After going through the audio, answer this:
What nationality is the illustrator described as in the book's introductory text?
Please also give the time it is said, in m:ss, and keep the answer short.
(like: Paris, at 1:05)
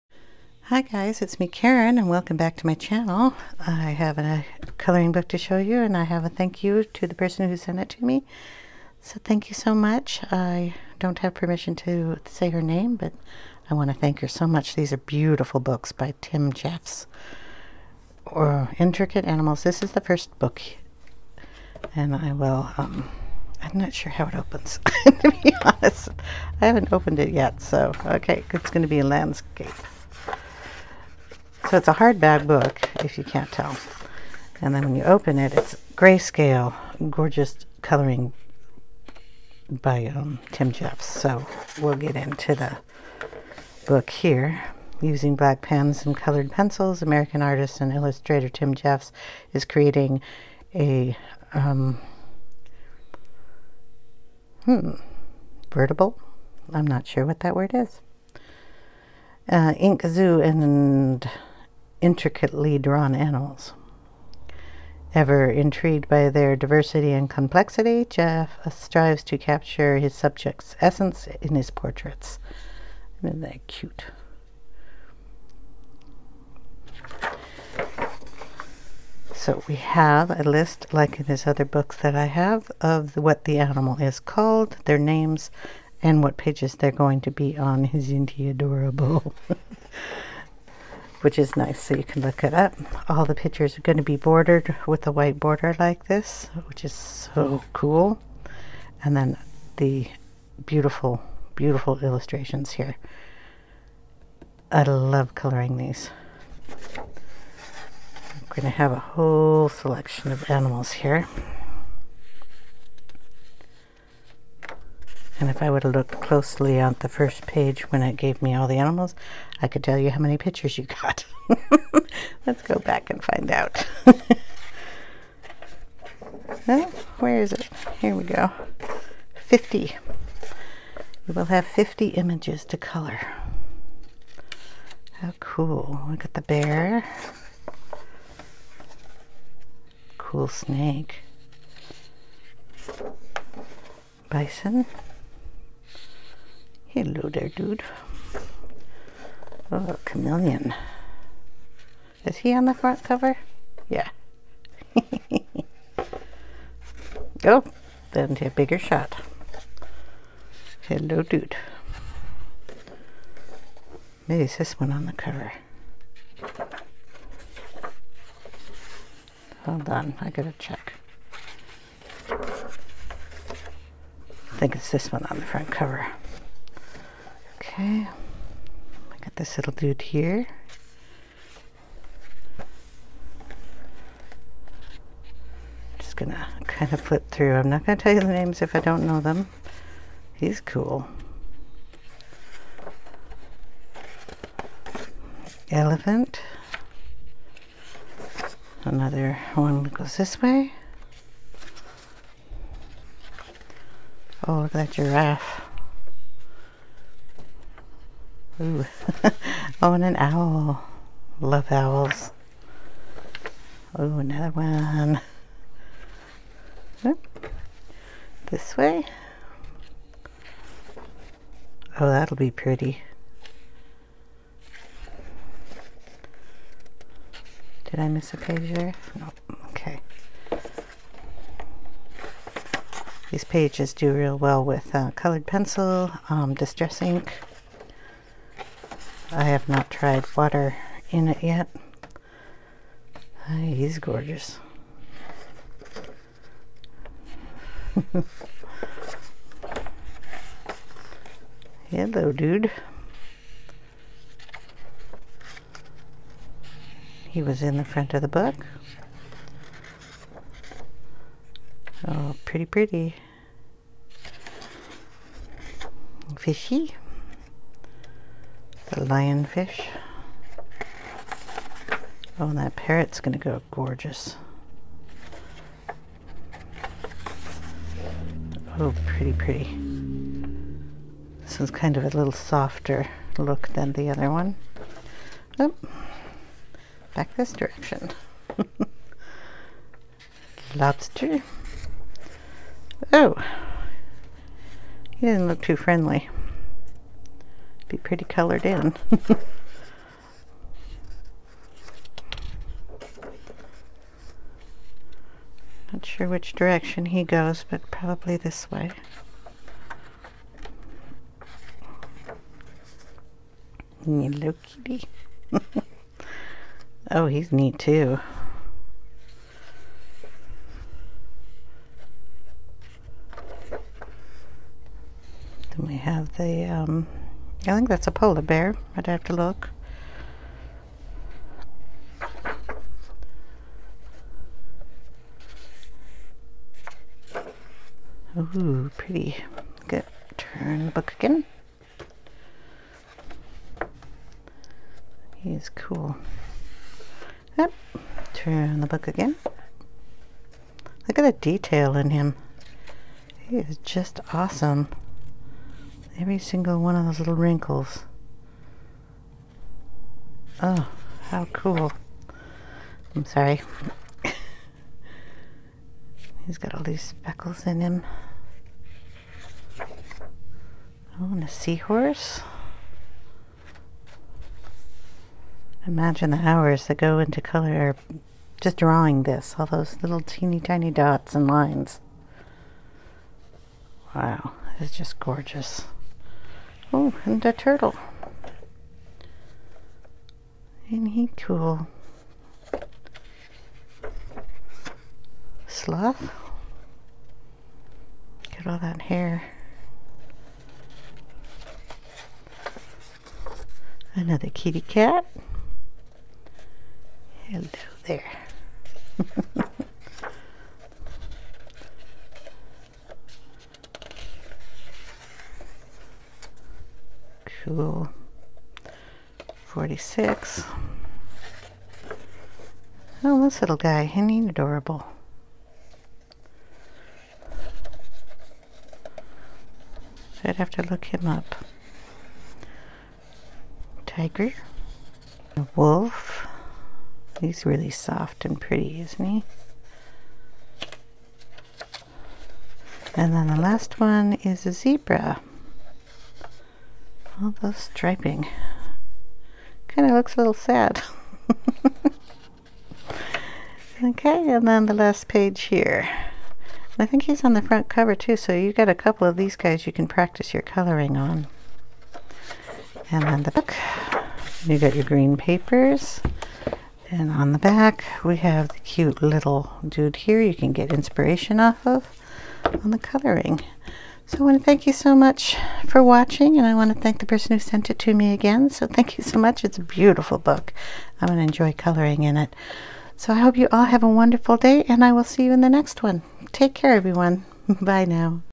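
American, at 0:47.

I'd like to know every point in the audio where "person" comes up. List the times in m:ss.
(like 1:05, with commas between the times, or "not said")
0:07, 7:57.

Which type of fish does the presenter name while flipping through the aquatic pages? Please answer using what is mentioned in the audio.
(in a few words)
lionfish.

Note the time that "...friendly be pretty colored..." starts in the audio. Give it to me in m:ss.
4:55.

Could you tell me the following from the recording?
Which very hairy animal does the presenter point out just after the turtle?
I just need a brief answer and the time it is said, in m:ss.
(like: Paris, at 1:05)
Sloth, at 6:35.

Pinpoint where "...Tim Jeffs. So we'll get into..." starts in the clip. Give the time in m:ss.
0:40.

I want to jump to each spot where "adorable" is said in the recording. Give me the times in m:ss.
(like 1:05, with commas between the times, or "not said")
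1:28, 7:04.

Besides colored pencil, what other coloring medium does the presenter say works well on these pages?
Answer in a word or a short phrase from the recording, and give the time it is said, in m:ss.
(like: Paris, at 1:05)
distress ink, at 3:56.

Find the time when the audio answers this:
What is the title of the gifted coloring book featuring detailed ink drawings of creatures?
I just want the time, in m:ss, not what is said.
0:18.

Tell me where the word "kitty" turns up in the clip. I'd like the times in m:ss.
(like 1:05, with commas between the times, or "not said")
5:14, 6:44.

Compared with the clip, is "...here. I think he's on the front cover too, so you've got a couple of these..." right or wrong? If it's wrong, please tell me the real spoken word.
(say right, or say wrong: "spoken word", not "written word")
right.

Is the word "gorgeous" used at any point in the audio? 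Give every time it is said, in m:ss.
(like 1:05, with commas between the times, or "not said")
0:37, 4:03, 4:33, 6:25.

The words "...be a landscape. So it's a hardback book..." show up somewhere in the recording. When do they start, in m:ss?
0:28.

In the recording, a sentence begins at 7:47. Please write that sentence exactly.
And on the back, we have the cute little dude here you can get inspiration off of on the coloring.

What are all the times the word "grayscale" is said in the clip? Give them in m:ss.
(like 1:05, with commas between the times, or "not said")
0:35.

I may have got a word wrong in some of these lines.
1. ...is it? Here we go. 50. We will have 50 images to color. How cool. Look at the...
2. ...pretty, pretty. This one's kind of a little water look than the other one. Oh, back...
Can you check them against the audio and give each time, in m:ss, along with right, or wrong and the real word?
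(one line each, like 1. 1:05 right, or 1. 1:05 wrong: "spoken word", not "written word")
1. 2:07 right
2. 4:39 wrong: "softer", not "water".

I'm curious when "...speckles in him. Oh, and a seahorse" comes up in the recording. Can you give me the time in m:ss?
6:07.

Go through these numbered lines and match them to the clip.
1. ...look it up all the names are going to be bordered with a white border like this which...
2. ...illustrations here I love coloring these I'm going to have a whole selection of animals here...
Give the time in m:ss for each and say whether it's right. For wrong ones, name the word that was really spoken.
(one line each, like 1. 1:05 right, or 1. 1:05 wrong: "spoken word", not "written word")
1. 1:32 wrong: "pictures", not "names"
2. 1:42 right.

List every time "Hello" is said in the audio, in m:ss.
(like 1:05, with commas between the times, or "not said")
2:26, 2:40, 4:11, 5:14, 6:47.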